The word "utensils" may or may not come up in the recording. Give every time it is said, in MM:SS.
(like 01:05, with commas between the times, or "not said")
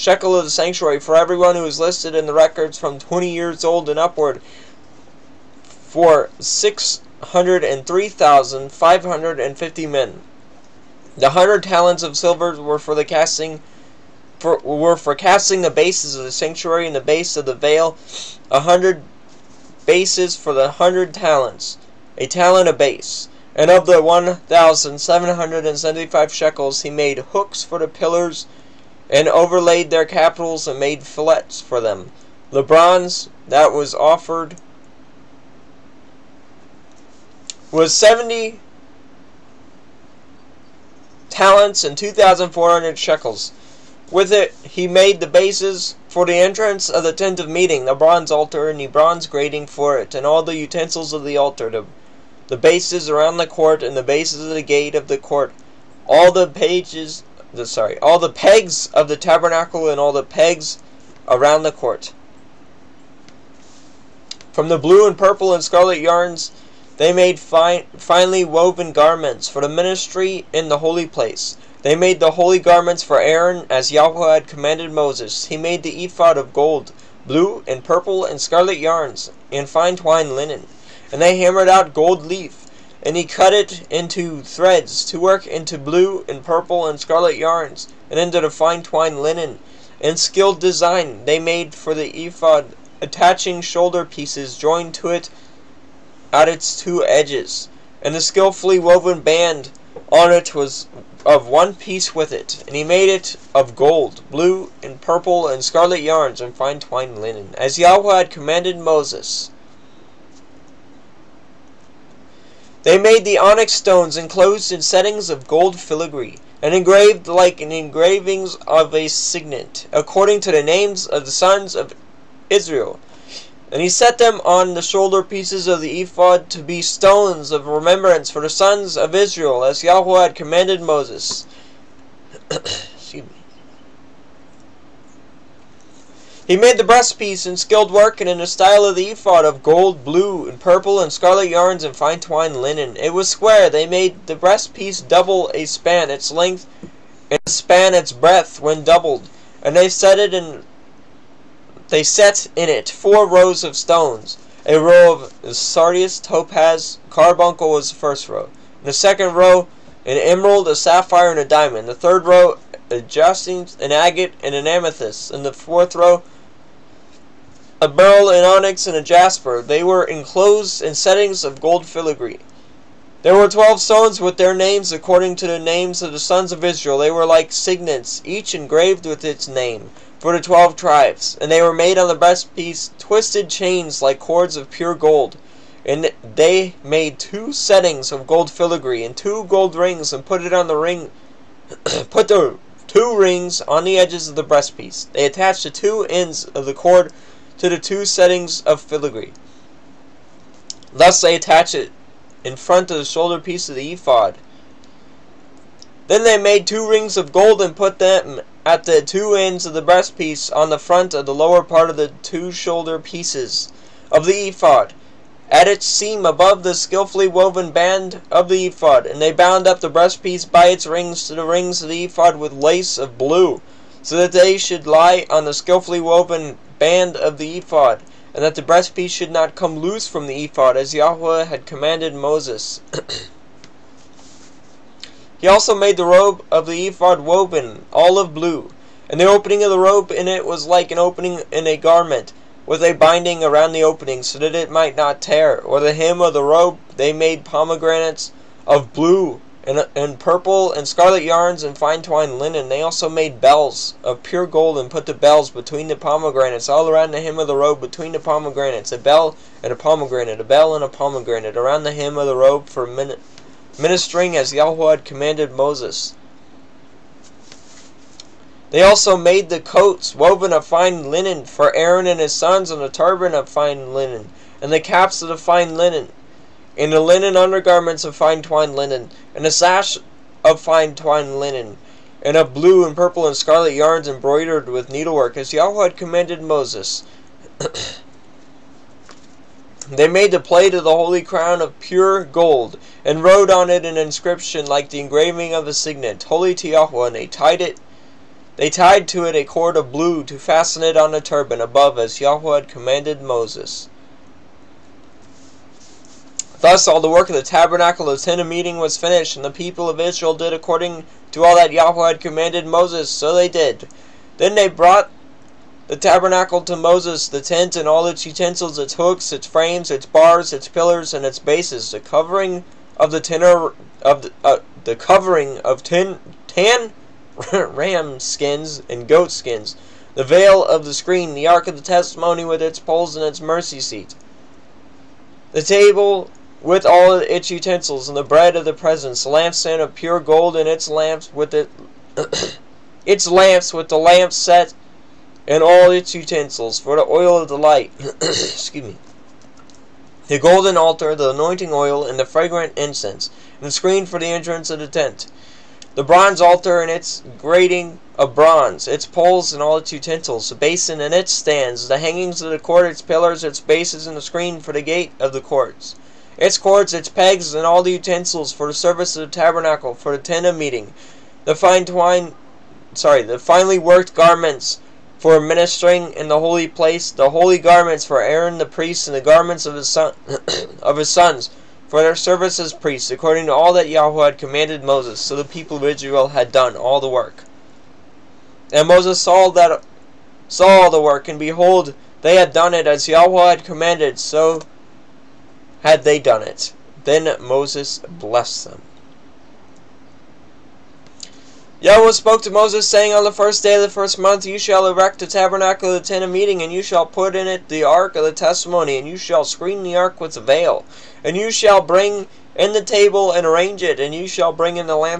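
00:50, 05:18, 05:37, 05:46, 05:59, 06:07.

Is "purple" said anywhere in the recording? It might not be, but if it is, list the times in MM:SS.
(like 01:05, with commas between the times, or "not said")
01:05, 01:17, 01:26, 01:44, 02:20, 04:10, 04:42.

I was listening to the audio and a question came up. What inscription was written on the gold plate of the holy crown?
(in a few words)
Holy to Yahweh.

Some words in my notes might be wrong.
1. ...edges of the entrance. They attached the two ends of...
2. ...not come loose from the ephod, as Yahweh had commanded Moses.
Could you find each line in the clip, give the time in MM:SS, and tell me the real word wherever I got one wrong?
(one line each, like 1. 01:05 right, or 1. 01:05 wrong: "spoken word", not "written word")
1. 03:13 wrong: "breastpiece", not "entrance"
2. 03:49 right.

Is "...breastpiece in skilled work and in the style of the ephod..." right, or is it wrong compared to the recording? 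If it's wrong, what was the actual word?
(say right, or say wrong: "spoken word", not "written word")
right.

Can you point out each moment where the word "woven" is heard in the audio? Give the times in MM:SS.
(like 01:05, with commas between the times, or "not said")
01:08, 01:38, 03:37, 03:45, 03:57, 04:30.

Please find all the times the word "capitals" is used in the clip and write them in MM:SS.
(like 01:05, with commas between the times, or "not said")
00:30.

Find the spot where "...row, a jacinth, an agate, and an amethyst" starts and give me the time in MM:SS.
02:42.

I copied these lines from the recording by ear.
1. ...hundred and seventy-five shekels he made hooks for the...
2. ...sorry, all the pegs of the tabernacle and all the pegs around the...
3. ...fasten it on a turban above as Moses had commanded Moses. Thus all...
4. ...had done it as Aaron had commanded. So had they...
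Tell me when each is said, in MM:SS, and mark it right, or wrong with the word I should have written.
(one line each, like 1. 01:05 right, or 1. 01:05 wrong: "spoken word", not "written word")
1. 00:25 right
2. 00:57 right
3. 05:00 wrong: "Yahweh", not "Moses"
4. 06:32 wrong: "Yahweh", not "Aaron".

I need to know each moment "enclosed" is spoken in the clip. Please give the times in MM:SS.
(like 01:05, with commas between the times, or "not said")
01:54, 02:50.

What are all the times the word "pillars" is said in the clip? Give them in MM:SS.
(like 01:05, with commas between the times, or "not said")
00:27, 05:20, 06:03.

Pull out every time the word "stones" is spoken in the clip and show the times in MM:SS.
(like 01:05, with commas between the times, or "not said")
01:53, 02:06, 02:33, 02:53.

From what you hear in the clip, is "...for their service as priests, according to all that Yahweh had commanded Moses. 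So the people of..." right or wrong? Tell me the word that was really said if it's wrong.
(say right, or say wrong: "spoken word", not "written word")
right.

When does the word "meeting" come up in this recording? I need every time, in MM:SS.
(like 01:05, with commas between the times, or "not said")
00:47, 05:08, 06:10, 06:46.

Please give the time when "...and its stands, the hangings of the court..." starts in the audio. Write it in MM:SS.
06:00.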